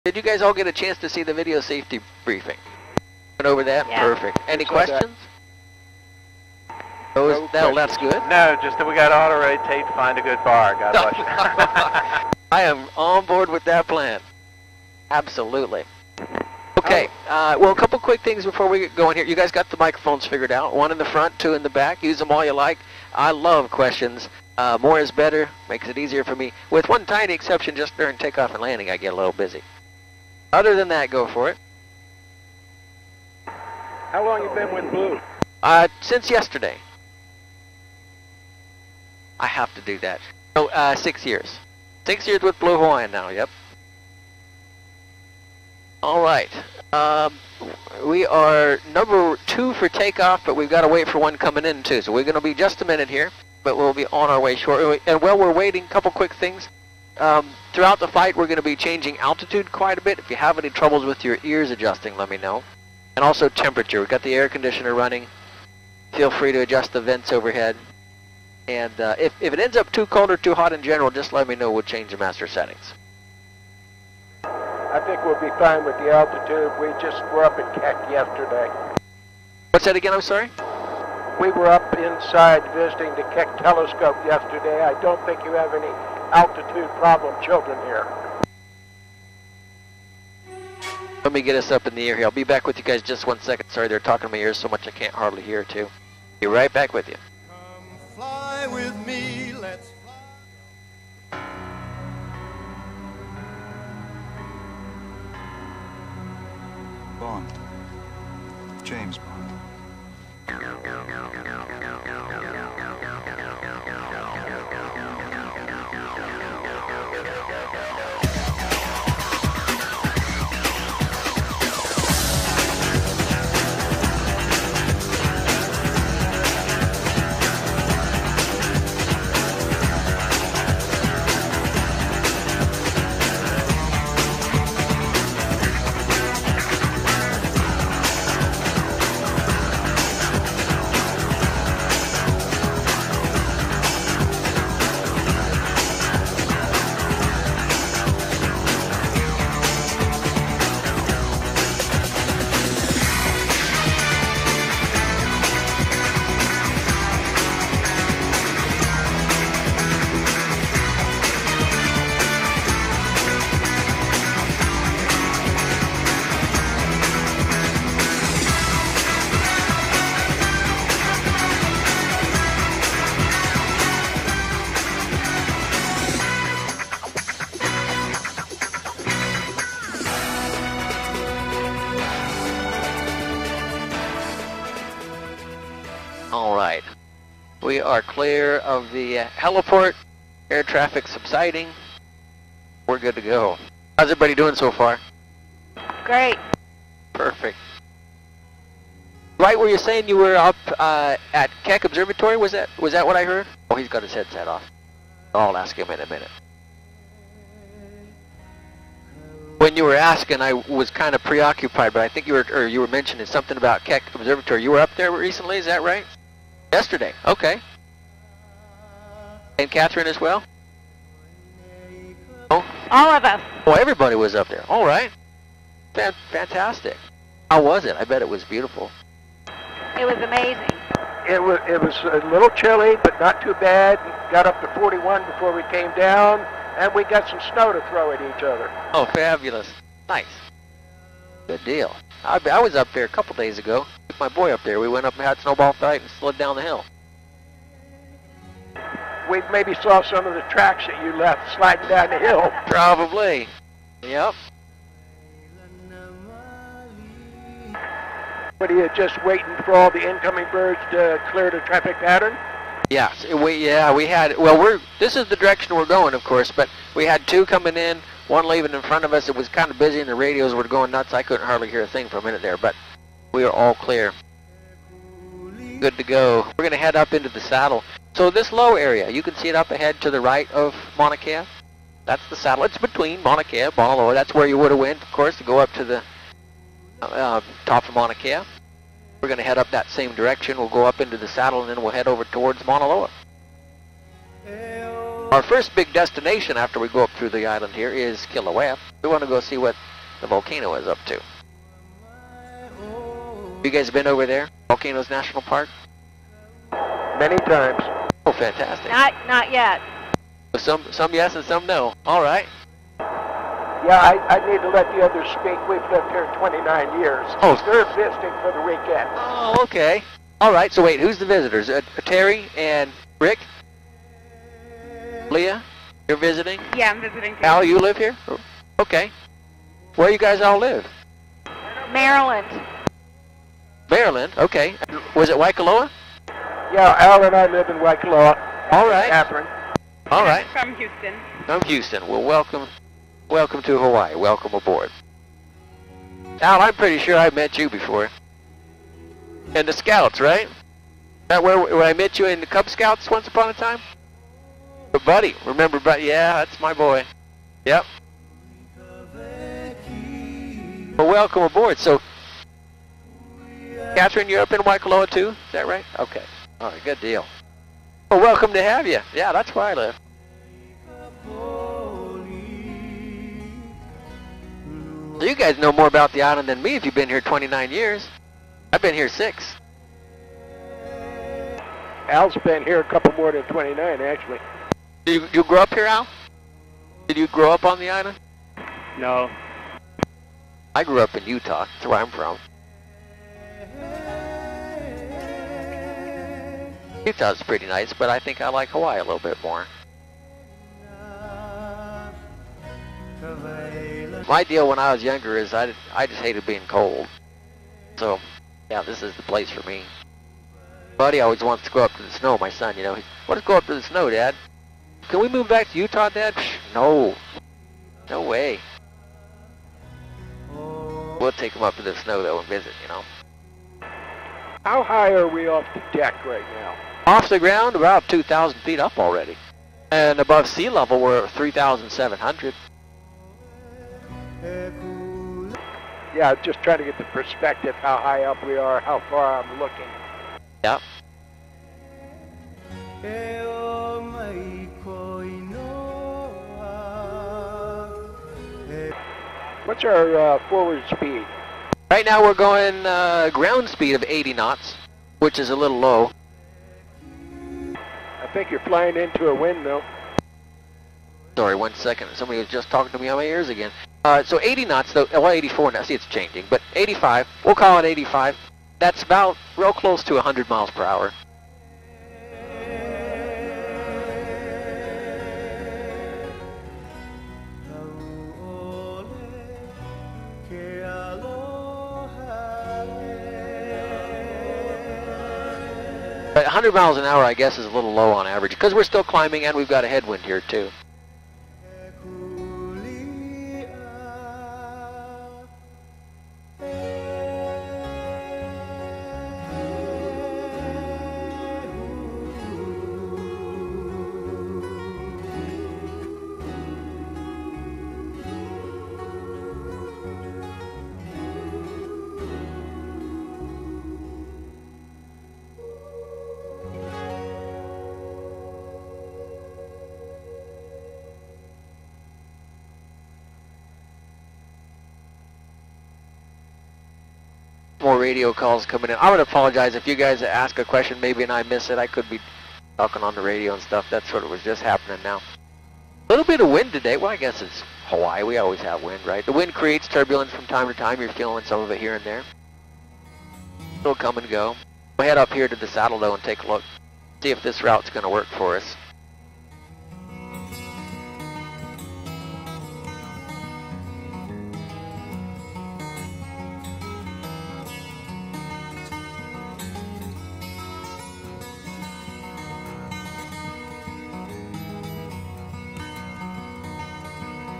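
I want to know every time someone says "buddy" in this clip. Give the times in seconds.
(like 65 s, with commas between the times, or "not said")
355 s, 410 s.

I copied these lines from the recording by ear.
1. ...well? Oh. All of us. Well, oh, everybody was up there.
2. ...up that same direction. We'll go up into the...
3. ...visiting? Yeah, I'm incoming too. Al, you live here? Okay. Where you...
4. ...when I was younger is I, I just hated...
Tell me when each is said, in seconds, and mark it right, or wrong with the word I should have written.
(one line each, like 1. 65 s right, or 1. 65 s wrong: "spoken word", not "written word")
1. 220 s right
2. 289 s right
3. 326 s wrong: "visiting", not "incoming"
4. 404 s right.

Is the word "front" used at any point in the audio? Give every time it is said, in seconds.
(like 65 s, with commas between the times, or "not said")
21 s, 268 s.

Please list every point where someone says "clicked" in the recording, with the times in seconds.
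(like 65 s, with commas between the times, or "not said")
not said.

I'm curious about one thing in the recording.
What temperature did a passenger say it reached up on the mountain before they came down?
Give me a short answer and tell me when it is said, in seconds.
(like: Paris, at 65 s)
41, at 234 s.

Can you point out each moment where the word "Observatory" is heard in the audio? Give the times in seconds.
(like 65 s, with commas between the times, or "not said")
201 s, 214 s.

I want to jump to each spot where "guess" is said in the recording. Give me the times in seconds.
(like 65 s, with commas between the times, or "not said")
487 s, 537 s.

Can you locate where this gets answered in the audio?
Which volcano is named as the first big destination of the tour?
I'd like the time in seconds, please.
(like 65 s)
298 s.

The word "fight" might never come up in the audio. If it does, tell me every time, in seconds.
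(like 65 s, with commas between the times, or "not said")
58 s, 245 s.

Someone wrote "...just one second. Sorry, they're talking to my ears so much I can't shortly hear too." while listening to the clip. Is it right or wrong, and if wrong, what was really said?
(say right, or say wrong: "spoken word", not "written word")
wrong: "hardly", not "shortly".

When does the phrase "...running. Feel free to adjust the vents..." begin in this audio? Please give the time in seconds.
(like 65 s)
64 s.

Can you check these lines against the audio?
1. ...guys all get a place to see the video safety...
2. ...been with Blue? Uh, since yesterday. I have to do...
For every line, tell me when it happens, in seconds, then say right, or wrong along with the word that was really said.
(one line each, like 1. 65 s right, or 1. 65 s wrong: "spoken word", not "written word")
1. 0 s wrong: "chance", not "place"
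2. 34 s right.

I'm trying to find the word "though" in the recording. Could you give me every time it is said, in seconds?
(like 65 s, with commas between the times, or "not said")
422 s, 464 s, 545 s.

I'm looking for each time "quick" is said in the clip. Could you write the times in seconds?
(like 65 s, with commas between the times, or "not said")
17 s, 56 s.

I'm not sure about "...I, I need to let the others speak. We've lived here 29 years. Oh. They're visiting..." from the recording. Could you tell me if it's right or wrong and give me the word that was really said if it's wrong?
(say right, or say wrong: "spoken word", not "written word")
right.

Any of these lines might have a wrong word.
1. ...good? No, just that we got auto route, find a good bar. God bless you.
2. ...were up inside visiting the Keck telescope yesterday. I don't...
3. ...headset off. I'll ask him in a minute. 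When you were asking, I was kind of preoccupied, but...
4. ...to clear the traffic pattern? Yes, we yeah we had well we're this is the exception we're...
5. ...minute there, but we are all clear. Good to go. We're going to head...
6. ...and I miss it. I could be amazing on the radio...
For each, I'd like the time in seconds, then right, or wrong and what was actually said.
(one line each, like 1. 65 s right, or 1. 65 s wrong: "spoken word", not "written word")
1. 7 s wrong: "rotate", not "route"
2. 81 s right
3. 204 s right
4. 260 s wrong: "direction", not "exception"
5. 272 s right
6. 531 s wrong: "talking", not "amazing".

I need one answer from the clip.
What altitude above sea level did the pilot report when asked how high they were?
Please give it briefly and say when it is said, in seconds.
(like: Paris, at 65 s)
3,700 feet, at 431 s.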